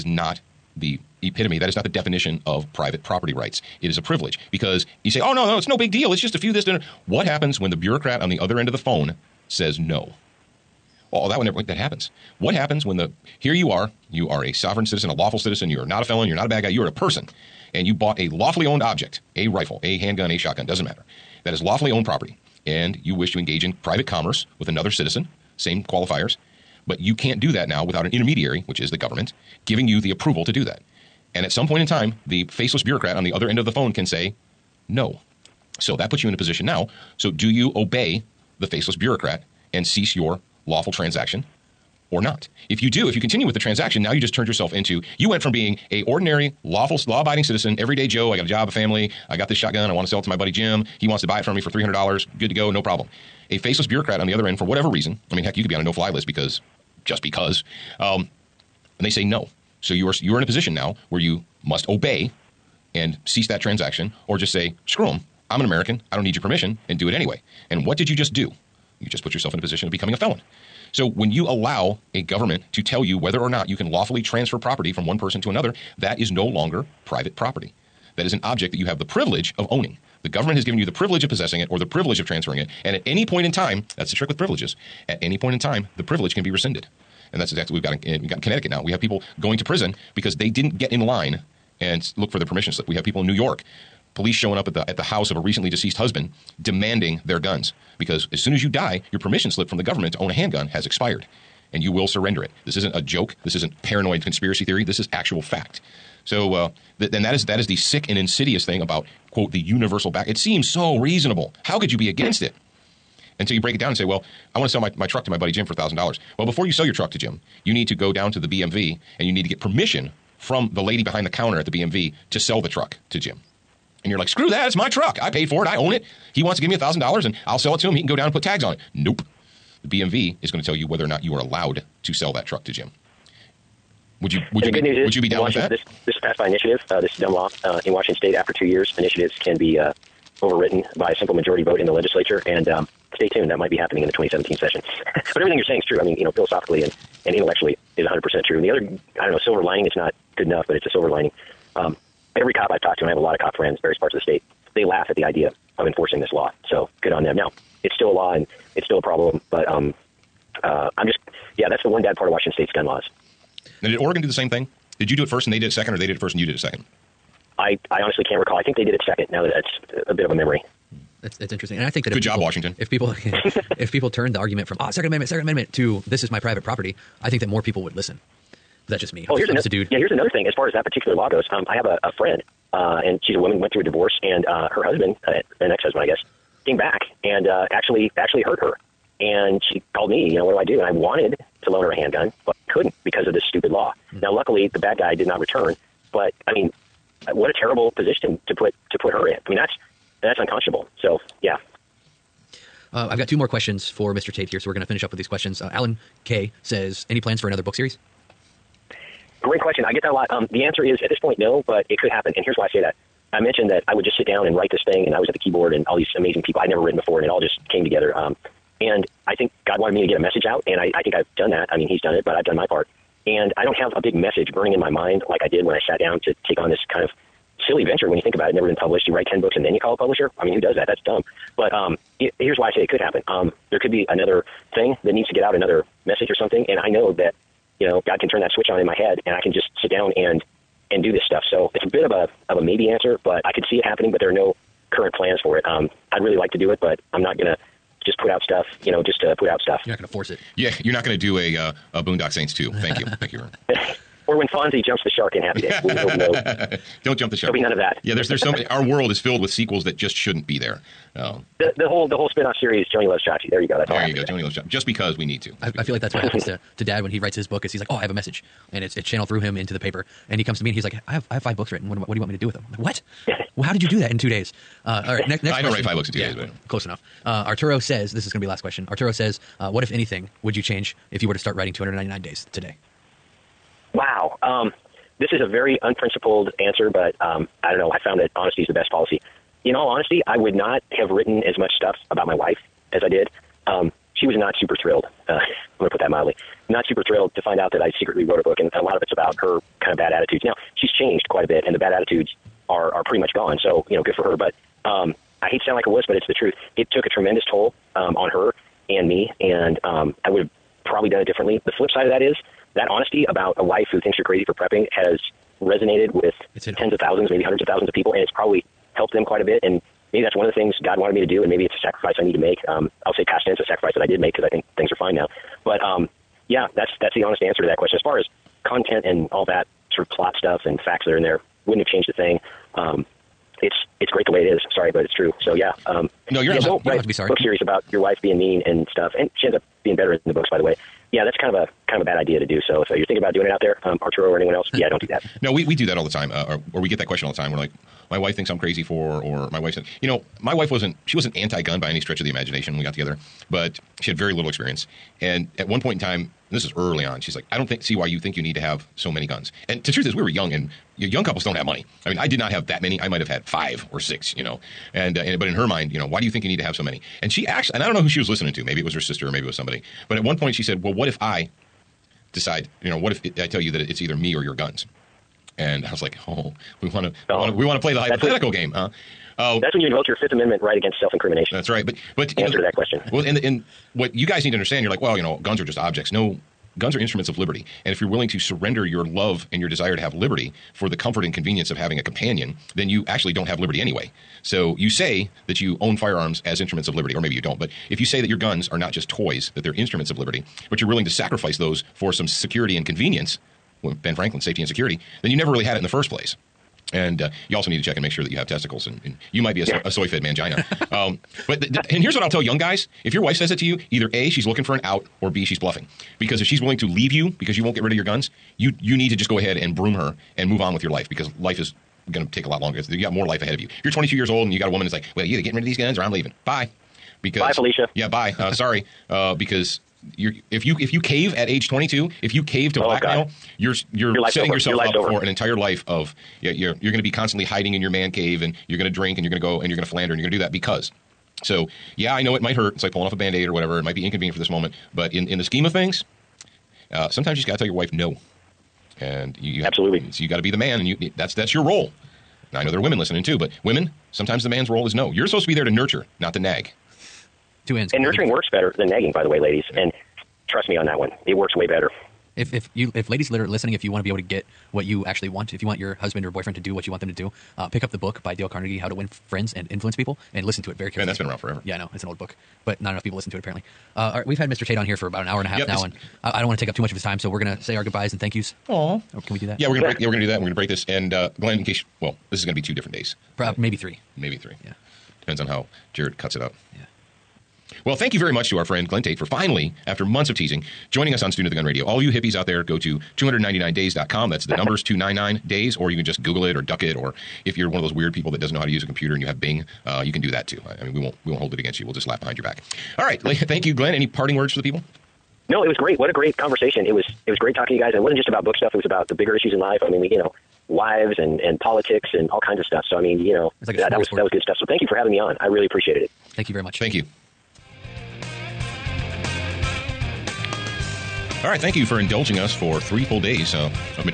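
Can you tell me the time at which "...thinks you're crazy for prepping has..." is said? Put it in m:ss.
5:14.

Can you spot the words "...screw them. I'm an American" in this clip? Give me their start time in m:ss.
1:04.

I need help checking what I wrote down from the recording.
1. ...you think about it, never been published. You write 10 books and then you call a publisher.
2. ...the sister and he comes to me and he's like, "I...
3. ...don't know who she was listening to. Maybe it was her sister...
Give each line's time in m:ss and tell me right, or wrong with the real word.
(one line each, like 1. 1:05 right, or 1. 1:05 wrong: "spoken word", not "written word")
1. 3:48 right
2. 4:29 wrong: "paper", not "sister"
3. 6:07 right.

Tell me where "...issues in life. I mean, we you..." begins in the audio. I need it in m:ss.
8:29.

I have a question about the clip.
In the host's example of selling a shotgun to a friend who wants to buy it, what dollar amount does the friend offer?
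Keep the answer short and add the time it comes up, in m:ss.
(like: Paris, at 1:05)
$300, at 0:51.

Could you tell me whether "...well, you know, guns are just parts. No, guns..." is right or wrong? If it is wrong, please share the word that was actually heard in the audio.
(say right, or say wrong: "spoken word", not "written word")
wrong: "objects", not "parts".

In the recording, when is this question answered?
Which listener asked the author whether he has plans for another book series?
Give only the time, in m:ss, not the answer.
3:25.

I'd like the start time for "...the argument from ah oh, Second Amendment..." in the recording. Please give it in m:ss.
2:54.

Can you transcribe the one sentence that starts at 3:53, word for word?
Um, there could be another thing that needs to get out, another message or something.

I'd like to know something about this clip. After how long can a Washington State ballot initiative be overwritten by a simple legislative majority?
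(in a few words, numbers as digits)
2 years.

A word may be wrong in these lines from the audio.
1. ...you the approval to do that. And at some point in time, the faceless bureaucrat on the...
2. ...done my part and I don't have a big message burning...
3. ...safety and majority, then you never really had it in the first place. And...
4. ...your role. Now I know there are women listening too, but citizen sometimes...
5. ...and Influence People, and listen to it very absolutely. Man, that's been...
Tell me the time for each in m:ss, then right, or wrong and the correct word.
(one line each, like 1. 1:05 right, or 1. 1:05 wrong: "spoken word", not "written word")
1. 0:29 right
2. 3:42 right
3. 6:44 wrong: "security", not "majority"
4. 7:31 wrong: "women", not "citizen"
5. 7:49 wrong: "carefully", not "absolutely".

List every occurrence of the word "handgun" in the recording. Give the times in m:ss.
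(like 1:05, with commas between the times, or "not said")
0:19, 1:40, 3:11.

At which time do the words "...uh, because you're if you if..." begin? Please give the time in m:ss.
7:09.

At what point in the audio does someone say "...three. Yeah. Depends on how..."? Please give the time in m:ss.
8:04.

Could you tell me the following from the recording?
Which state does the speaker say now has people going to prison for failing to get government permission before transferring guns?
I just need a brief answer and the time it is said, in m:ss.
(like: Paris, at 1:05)
Connecticut, at 1:28.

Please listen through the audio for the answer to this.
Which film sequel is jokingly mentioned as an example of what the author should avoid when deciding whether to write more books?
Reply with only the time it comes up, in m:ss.
4:12.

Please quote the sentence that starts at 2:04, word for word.
And you're like, screw that, it's my truck.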